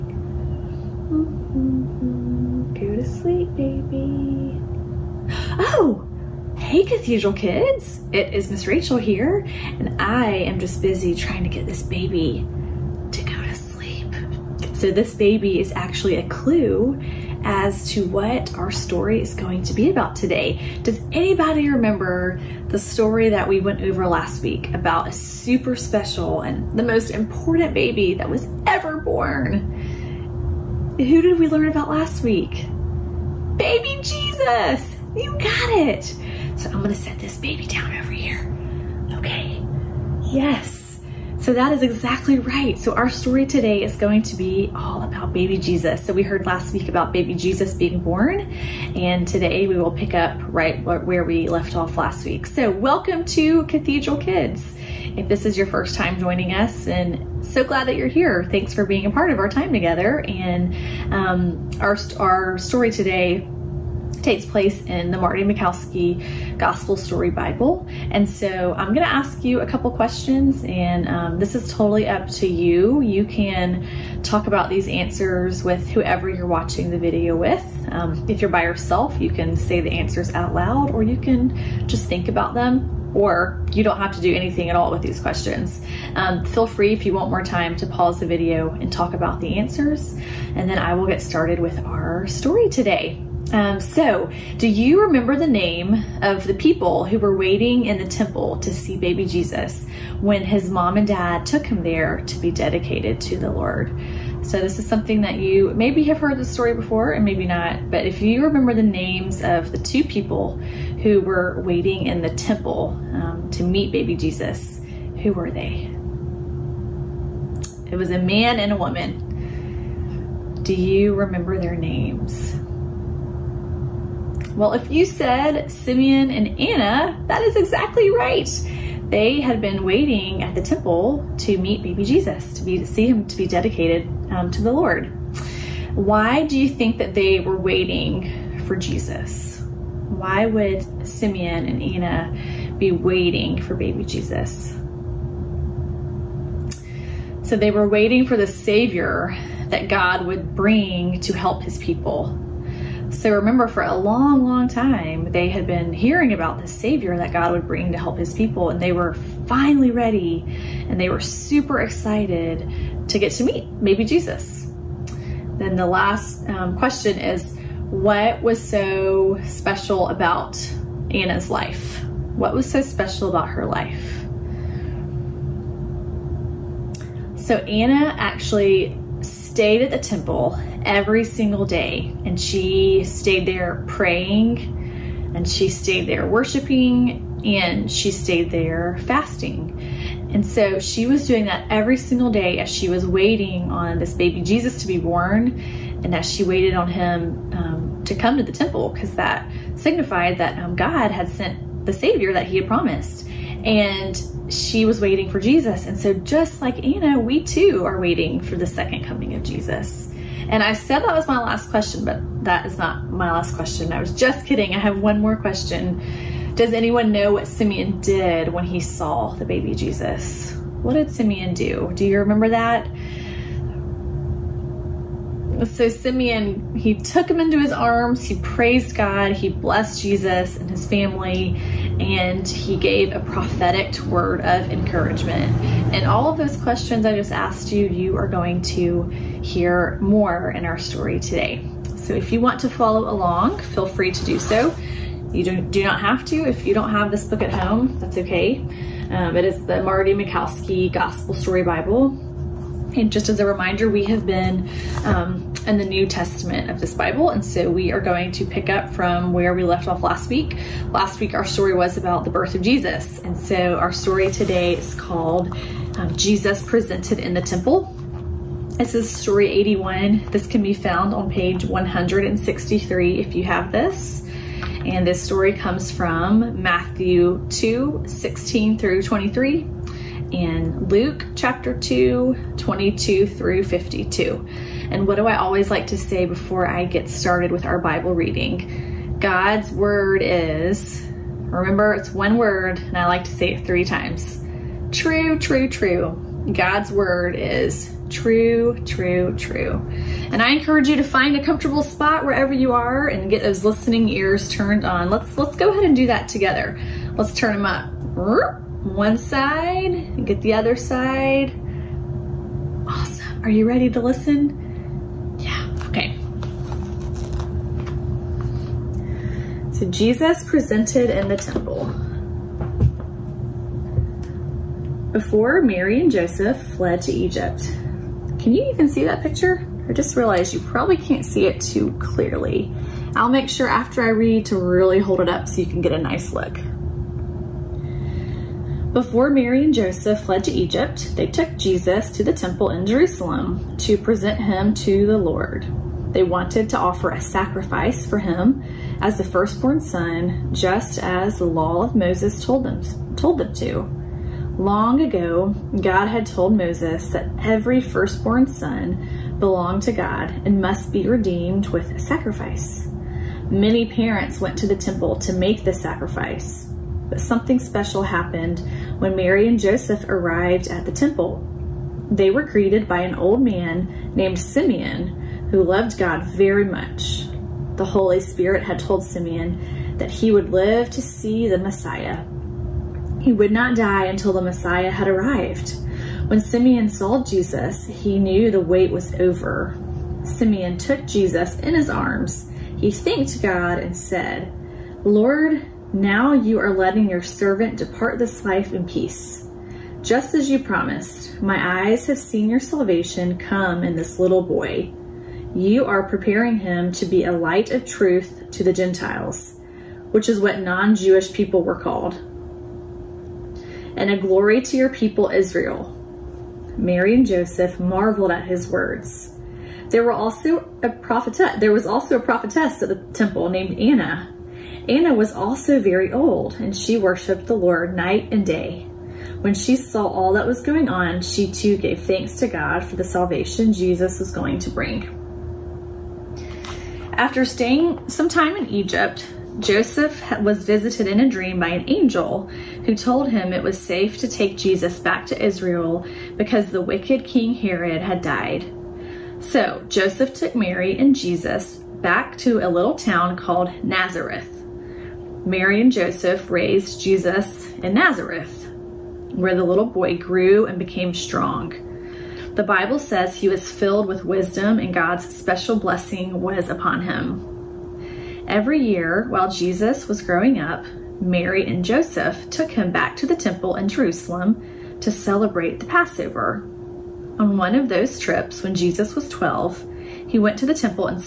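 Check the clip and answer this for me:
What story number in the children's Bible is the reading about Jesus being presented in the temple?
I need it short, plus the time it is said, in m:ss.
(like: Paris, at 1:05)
81, at 4:29.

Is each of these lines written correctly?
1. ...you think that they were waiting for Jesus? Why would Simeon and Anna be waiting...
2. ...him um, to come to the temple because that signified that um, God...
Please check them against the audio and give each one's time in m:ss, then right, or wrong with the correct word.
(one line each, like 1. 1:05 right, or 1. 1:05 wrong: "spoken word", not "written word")
1. 2:16 right
2. 3:16 right.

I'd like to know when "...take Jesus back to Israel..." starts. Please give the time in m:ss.
7:24.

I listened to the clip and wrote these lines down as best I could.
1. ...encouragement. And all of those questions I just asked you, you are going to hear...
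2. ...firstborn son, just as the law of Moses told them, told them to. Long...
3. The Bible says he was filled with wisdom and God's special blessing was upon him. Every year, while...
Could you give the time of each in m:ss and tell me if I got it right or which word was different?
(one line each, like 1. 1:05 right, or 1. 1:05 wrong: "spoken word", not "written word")
1. 3:54 right
2. 5:49 right
3. 7:42 right.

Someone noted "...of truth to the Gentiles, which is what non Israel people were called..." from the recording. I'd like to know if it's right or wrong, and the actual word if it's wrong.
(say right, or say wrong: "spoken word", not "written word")
wrong: "Jewish", not "Israel".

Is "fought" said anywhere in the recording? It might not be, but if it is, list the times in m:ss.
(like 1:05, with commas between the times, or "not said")
not said.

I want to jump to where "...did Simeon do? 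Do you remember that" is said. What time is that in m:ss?
3:40.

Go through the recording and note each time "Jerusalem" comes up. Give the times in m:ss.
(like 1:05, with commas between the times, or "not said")
5:42, 7:53.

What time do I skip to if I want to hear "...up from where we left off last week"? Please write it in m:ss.
4:18.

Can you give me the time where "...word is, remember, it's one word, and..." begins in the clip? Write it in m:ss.
4:49.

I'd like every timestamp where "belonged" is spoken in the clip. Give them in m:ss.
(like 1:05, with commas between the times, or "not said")
5:59.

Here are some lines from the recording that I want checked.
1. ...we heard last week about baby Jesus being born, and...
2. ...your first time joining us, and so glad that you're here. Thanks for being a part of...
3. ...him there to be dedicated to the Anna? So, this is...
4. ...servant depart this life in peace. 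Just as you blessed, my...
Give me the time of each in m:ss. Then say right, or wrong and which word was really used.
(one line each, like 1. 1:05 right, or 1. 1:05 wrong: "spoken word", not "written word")
1. 0:46 right
2. 0:55 right
3. 1:41 wrong: "Lord", not "Anna"
4. 6:37 wrong: "promised", not "blessed".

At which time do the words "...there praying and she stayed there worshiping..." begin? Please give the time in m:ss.
3:03.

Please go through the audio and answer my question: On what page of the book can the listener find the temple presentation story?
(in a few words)
163.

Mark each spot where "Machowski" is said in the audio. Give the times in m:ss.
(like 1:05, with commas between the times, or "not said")
1:05, 4:10.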